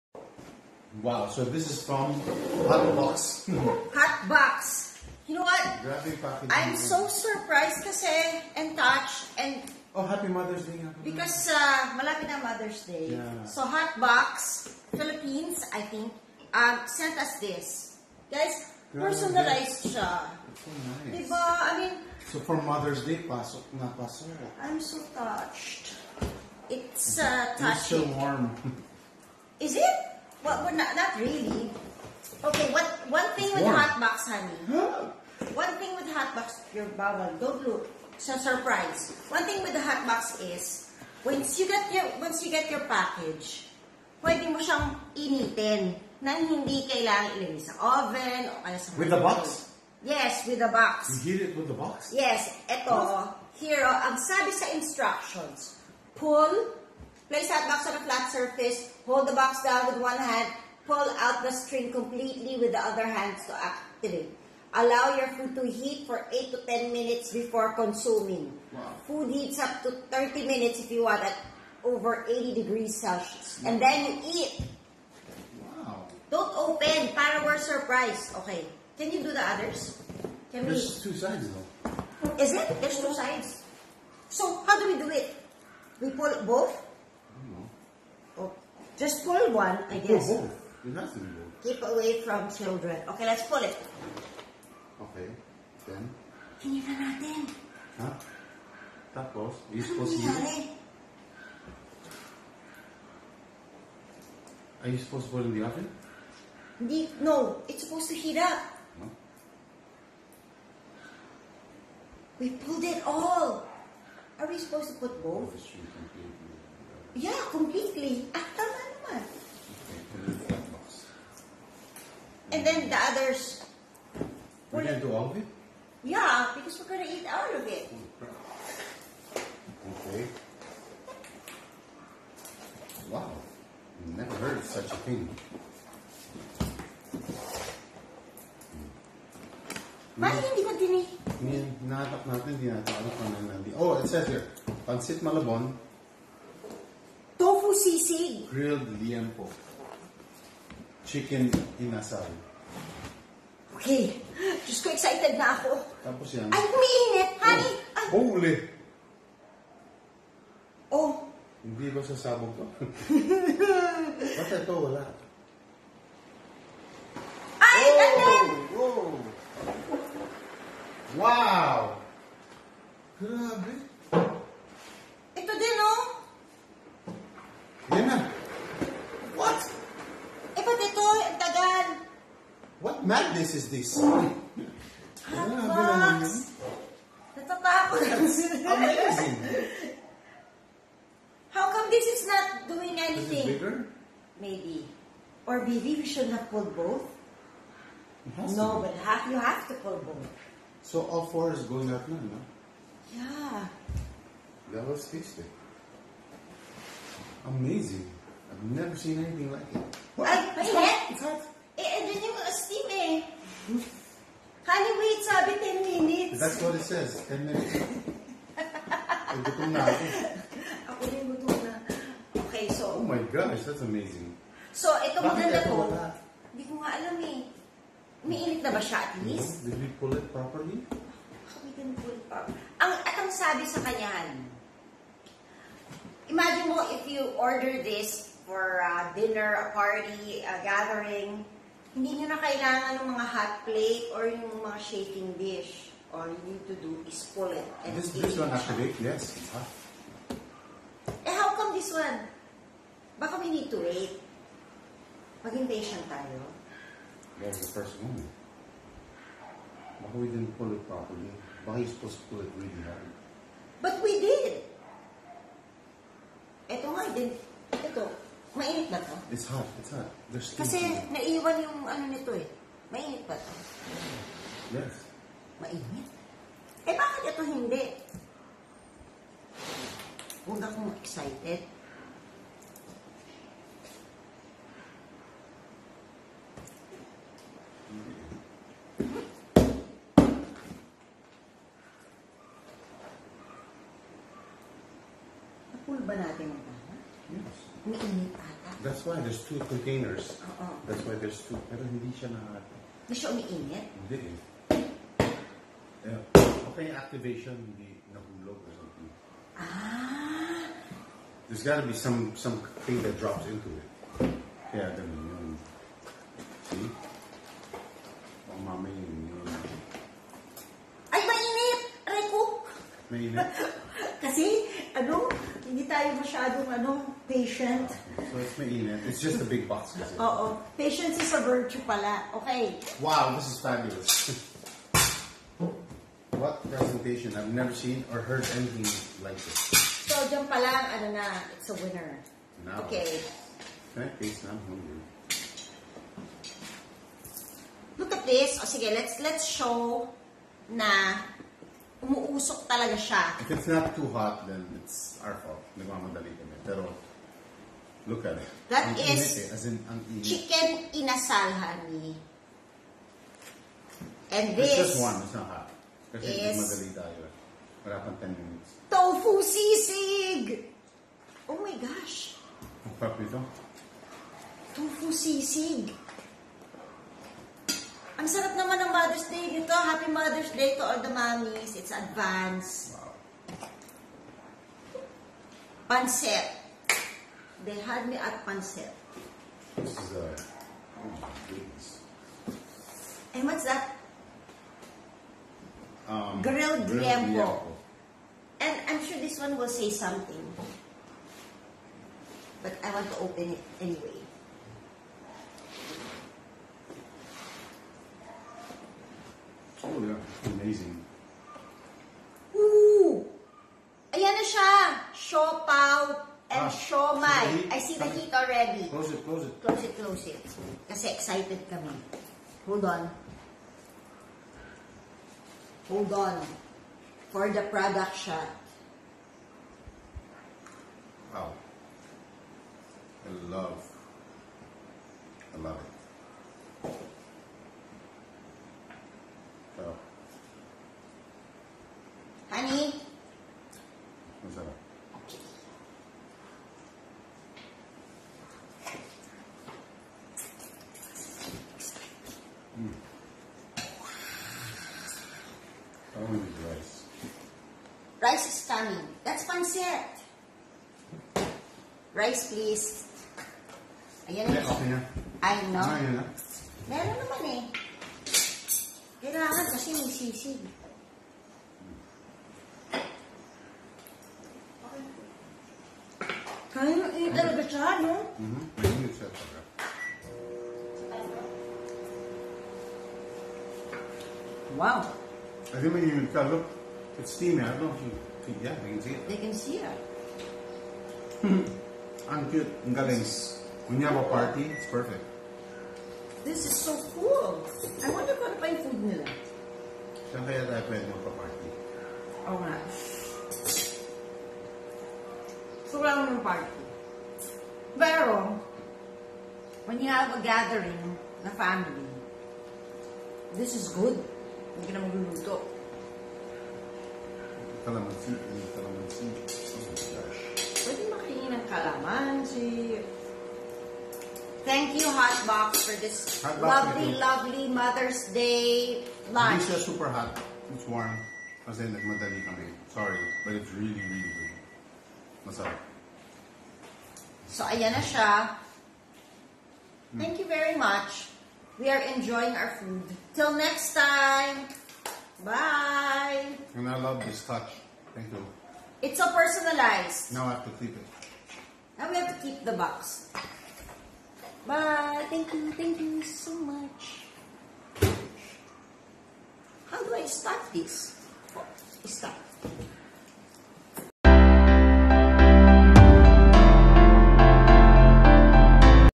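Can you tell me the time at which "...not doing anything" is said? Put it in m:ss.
3:12.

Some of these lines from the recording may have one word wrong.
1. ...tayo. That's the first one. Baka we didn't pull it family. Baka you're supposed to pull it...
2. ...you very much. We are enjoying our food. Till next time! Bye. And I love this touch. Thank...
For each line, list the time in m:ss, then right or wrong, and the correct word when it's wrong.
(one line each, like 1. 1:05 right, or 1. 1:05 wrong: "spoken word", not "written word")
1. 4:16 wrong: "properly", not "family"
2. 9:00 right.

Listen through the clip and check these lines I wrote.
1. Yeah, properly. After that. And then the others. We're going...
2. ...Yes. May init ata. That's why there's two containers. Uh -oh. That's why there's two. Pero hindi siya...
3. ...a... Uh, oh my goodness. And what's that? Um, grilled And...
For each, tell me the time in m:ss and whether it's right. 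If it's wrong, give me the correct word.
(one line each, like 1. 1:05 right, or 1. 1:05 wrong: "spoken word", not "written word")
1. 1:57 wrong: "completely", not "properly"
2. 4:57 right
3. 6:30 right.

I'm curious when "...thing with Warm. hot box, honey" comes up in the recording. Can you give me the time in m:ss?
0:33.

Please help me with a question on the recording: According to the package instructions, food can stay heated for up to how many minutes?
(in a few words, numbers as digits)
30 minutes.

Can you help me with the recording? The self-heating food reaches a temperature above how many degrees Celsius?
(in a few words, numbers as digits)
80 degrees Celsius.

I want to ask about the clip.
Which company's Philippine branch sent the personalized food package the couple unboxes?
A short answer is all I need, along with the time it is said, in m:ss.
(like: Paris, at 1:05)
Hot Box Philippines, at 0:13.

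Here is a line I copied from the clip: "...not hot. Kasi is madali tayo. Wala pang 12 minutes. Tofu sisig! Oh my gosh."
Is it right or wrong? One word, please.
wrong.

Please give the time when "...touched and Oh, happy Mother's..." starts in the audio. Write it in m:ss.
0:08.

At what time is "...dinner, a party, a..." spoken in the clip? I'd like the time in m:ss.
3:59.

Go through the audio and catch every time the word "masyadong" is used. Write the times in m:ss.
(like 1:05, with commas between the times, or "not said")
5:26.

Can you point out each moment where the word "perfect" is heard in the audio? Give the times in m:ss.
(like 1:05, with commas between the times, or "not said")
8:14.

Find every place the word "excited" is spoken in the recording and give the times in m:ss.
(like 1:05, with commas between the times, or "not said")
2:34, 4:41, 7:01.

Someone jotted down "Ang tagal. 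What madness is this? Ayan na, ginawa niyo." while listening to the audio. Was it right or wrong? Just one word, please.
right.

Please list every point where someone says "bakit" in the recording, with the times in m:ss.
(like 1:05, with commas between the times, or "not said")
2:20, 4:36.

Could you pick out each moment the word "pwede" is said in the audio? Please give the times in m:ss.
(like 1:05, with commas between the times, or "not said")
0:44, 8:20, 8:40.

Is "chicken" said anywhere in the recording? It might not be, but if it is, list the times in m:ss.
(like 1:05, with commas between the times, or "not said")
2:31, 6:00.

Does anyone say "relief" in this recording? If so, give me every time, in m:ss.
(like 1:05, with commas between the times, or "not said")
not said.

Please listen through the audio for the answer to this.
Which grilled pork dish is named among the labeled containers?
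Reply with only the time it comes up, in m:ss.
2:28.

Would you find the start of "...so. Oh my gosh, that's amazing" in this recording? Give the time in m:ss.
3:42.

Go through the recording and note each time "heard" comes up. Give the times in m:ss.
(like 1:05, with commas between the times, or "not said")
2:14, 5:38.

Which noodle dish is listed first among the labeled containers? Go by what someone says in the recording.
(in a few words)
Pancit Malabon.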